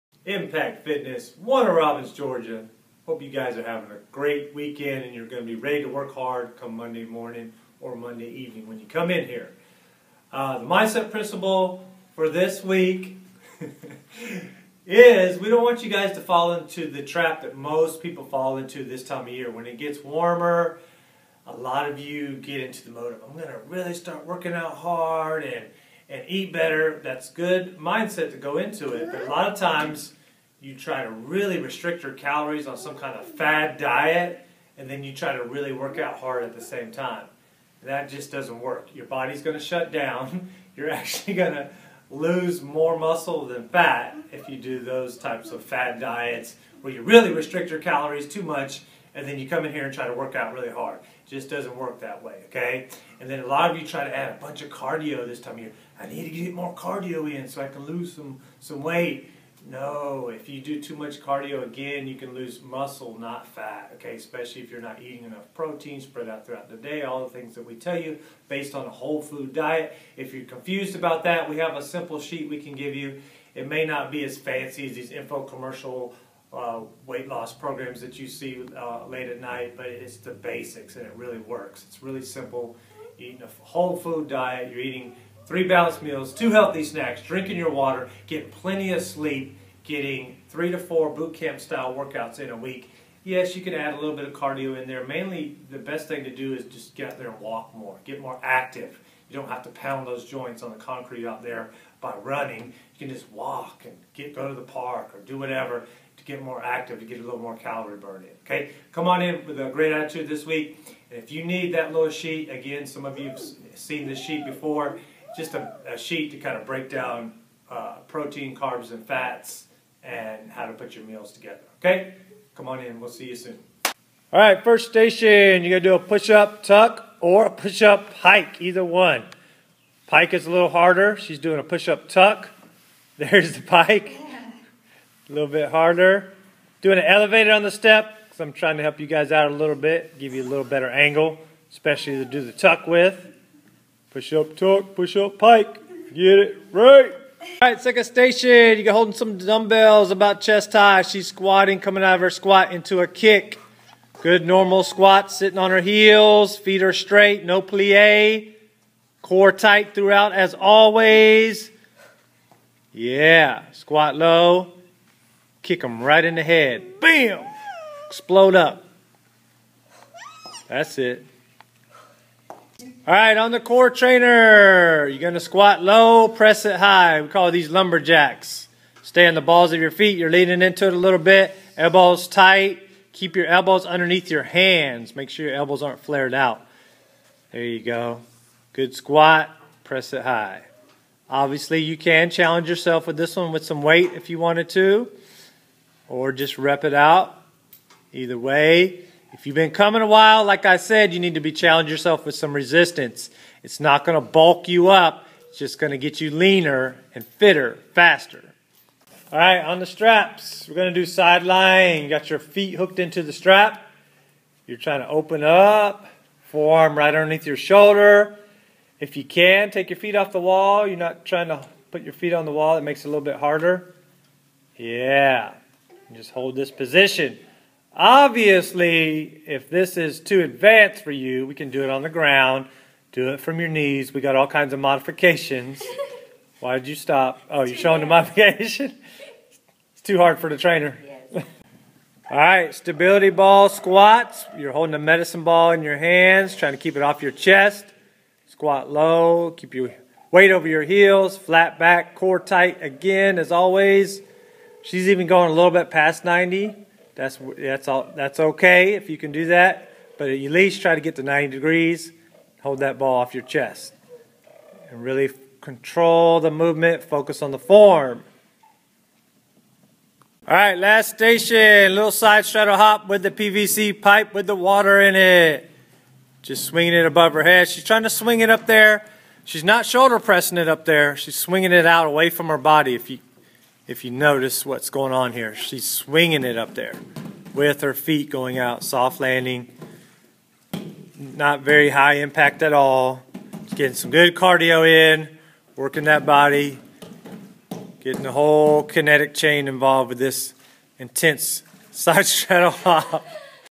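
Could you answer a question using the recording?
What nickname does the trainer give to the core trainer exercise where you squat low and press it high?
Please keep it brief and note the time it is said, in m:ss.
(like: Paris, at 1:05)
lumberjacks, at 2:57.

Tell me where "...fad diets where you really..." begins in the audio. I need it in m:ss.
0:45.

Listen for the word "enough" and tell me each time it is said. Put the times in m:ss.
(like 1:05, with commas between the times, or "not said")
1:05.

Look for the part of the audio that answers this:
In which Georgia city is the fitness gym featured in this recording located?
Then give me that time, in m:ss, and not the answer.
0:01.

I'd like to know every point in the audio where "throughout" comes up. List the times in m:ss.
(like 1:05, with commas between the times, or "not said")
1:06, 2:39.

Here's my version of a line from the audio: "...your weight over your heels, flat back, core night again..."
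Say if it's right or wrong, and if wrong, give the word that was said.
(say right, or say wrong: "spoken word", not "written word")
wrong: "tight", not "night".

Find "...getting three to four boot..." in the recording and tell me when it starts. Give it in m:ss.
1:29.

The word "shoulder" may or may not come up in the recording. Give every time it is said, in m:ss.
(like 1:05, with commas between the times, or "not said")
3:37, 4:39.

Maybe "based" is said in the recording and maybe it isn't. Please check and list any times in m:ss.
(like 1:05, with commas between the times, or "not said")
1:08.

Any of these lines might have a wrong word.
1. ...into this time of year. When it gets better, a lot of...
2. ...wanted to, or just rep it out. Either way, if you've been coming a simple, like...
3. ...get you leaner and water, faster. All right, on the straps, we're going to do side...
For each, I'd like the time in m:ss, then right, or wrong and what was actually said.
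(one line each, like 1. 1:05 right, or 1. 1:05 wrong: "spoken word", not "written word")
1. 0:18 wrong: "warmer", not "better"
2. 3:14 wrong: "while", not "simple"
3. 3:25 wrong: "fitter", not "water".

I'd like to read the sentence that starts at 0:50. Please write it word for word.
It just doesn't work that way, okay?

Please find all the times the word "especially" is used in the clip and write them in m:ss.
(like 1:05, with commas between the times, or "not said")
1:04, 2:21.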